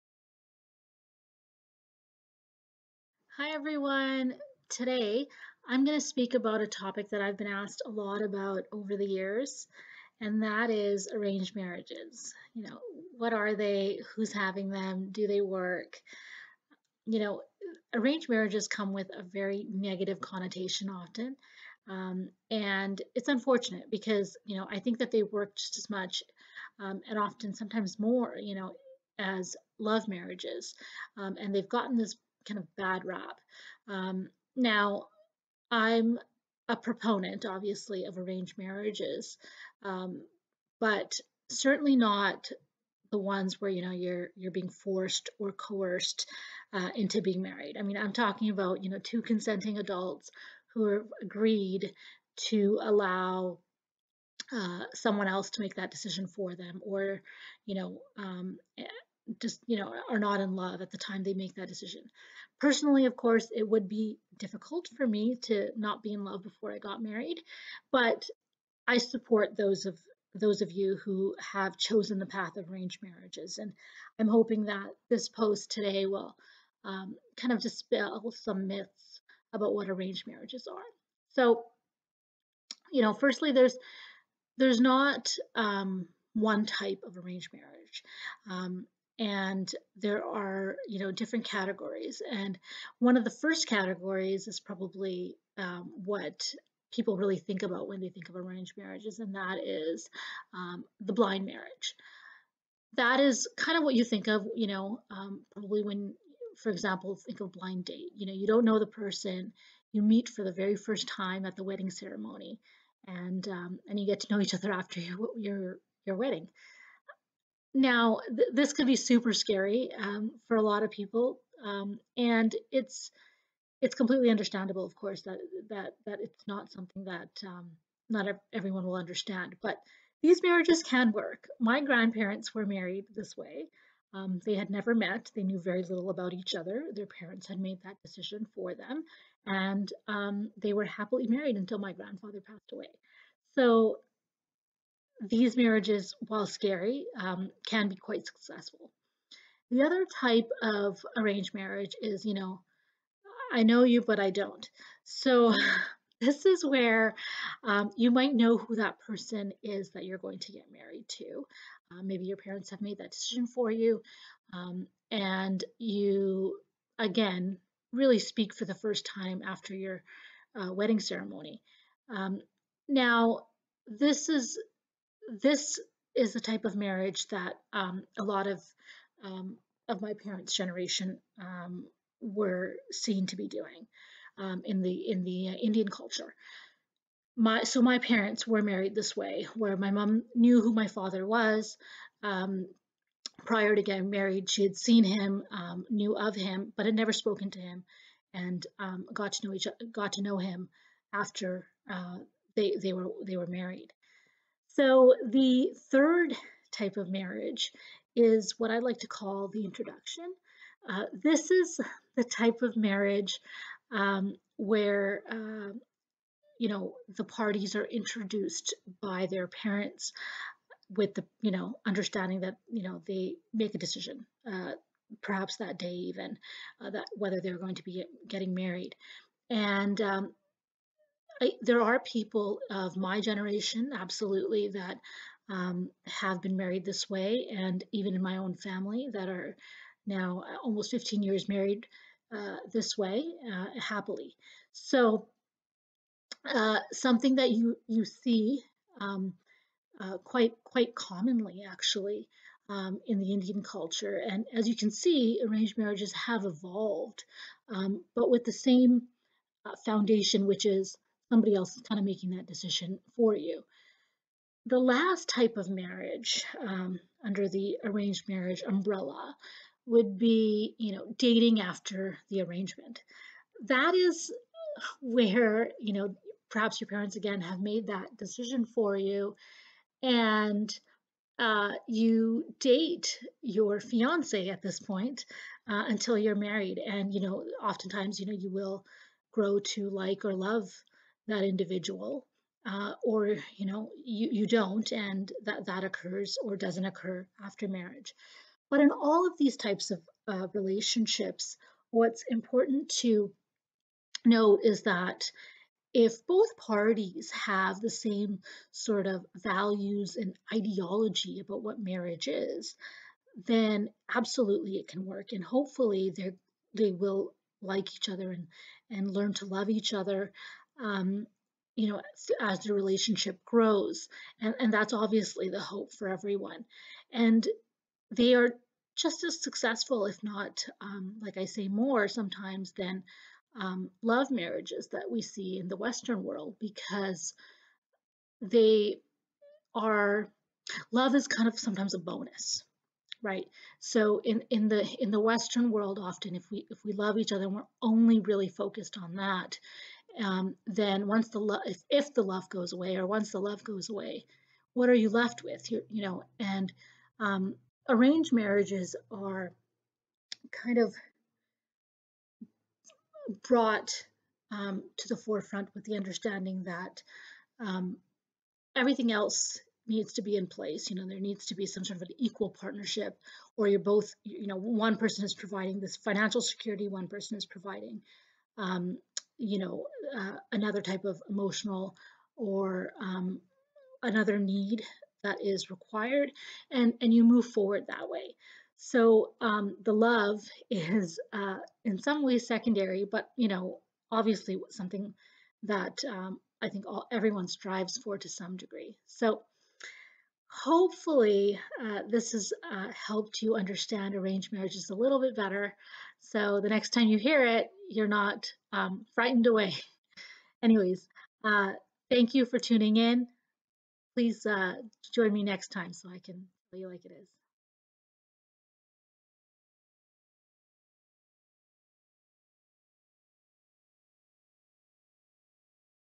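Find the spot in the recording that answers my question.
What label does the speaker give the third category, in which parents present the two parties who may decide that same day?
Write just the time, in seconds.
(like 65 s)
209 s.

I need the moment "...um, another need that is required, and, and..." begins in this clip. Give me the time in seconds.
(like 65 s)
383 s.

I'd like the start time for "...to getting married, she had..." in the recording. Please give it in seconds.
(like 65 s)
193 s.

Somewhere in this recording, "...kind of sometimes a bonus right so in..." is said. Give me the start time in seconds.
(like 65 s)
341 s.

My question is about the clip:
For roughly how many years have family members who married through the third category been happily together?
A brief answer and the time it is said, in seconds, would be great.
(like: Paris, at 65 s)
15 years, at 240 s.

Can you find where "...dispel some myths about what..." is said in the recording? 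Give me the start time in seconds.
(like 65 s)
77 s.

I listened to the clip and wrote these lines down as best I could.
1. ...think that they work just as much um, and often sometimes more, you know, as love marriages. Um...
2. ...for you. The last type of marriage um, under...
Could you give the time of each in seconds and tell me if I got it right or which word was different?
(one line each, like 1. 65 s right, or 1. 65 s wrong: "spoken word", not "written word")
1. 24 s right
2. 263 s right.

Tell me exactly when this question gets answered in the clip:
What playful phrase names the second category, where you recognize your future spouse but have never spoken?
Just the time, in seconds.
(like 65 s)
153 s.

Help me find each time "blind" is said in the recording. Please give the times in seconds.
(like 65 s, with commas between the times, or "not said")
101 s, 107 s.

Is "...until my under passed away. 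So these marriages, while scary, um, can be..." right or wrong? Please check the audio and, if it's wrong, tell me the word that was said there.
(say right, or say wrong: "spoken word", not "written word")
wrong: "grandfather", not "under".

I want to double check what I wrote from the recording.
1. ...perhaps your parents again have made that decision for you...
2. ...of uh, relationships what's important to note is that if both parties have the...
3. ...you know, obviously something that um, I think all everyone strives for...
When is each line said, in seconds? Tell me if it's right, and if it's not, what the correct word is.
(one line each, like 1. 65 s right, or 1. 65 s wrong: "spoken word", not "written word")
1. 276 s right
2. 299 s right
3. 393 s right.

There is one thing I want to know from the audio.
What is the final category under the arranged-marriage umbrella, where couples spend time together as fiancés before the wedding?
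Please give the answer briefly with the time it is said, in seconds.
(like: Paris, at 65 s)
Dating after the arrangement, at 271 s.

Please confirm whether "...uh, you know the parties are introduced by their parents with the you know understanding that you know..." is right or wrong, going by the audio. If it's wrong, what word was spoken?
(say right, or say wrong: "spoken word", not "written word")
right.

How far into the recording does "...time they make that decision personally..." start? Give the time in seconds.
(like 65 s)
60 s.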